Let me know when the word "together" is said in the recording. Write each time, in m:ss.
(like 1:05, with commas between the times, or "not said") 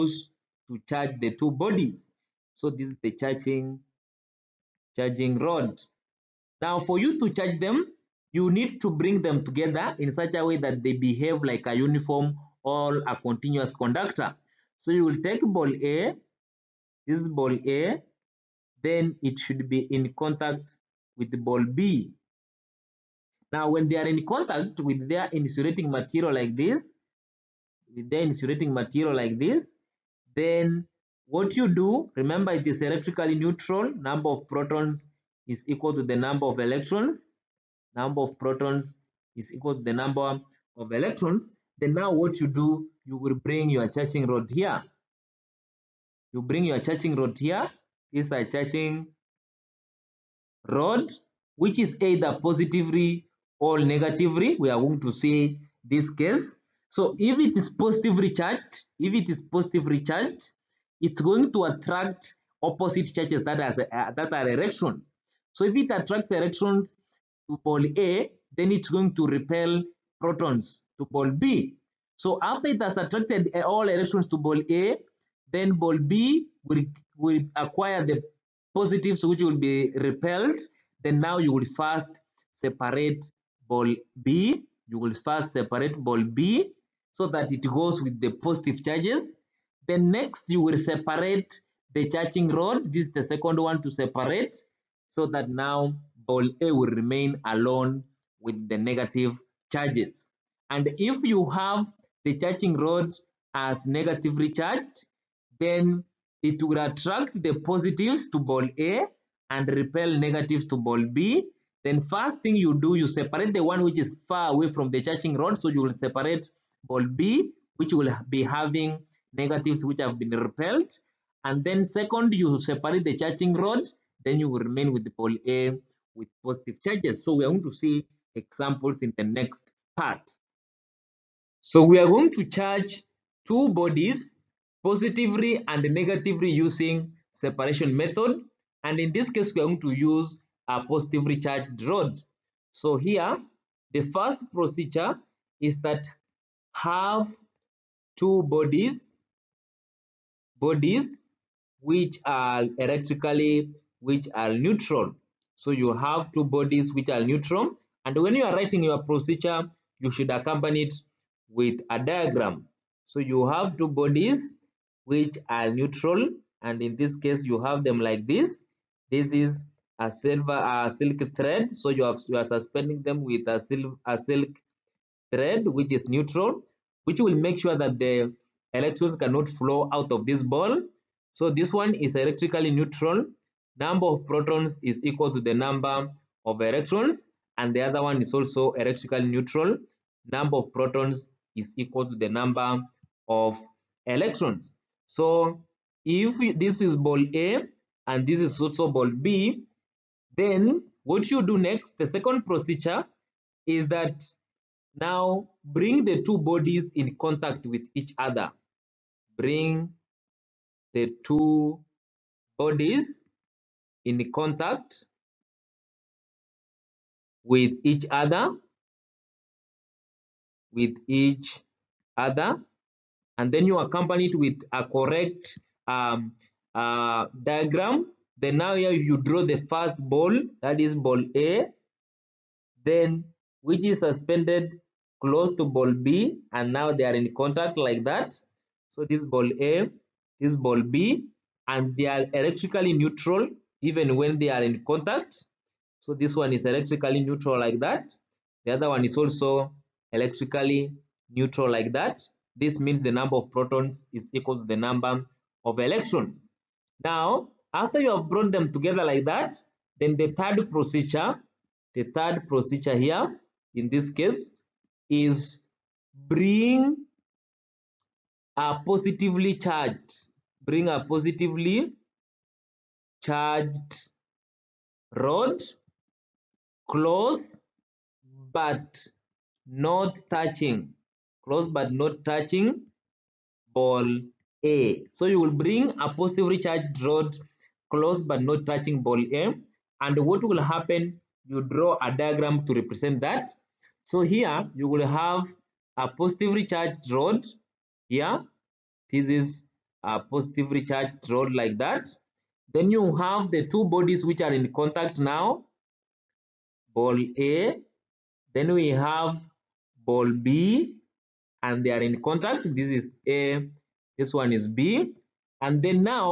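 0:09, 4:18.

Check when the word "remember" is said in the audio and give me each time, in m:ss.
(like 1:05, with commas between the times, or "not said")
0:32.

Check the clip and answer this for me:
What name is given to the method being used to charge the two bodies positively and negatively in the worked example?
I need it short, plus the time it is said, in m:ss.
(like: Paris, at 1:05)
Separation method, at 2:17.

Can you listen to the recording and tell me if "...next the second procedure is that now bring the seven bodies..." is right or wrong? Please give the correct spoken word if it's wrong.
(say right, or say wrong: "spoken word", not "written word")
wrong: "two", not "seven".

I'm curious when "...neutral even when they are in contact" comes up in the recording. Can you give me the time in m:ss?
4:02.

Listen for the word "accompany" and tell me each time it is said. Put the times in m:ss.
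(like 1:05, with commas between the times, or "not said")
2:40, 3:43.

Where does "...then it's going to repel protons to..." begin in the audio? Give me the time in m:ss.
1:08.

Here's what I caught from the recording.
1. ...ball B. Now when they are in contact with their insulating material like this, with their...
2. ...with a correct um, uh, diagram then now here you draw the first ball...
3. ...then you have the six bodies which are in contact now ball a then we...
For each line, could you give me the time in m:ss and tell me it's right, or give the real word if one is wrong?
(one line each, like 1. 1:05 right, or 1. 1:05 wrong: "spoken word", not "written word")
1. 0:21 right
2. 3:44 right
3. 5:02 wrong: "two", not "six".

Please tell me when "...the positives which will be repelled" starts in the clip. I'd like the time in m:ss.
1:18.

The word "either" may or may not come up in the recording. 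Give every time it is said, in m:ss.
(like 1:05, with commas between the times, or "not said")
0:52.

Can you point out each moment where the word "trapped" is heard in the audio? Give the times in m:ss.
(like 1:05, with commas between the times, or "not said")
not said.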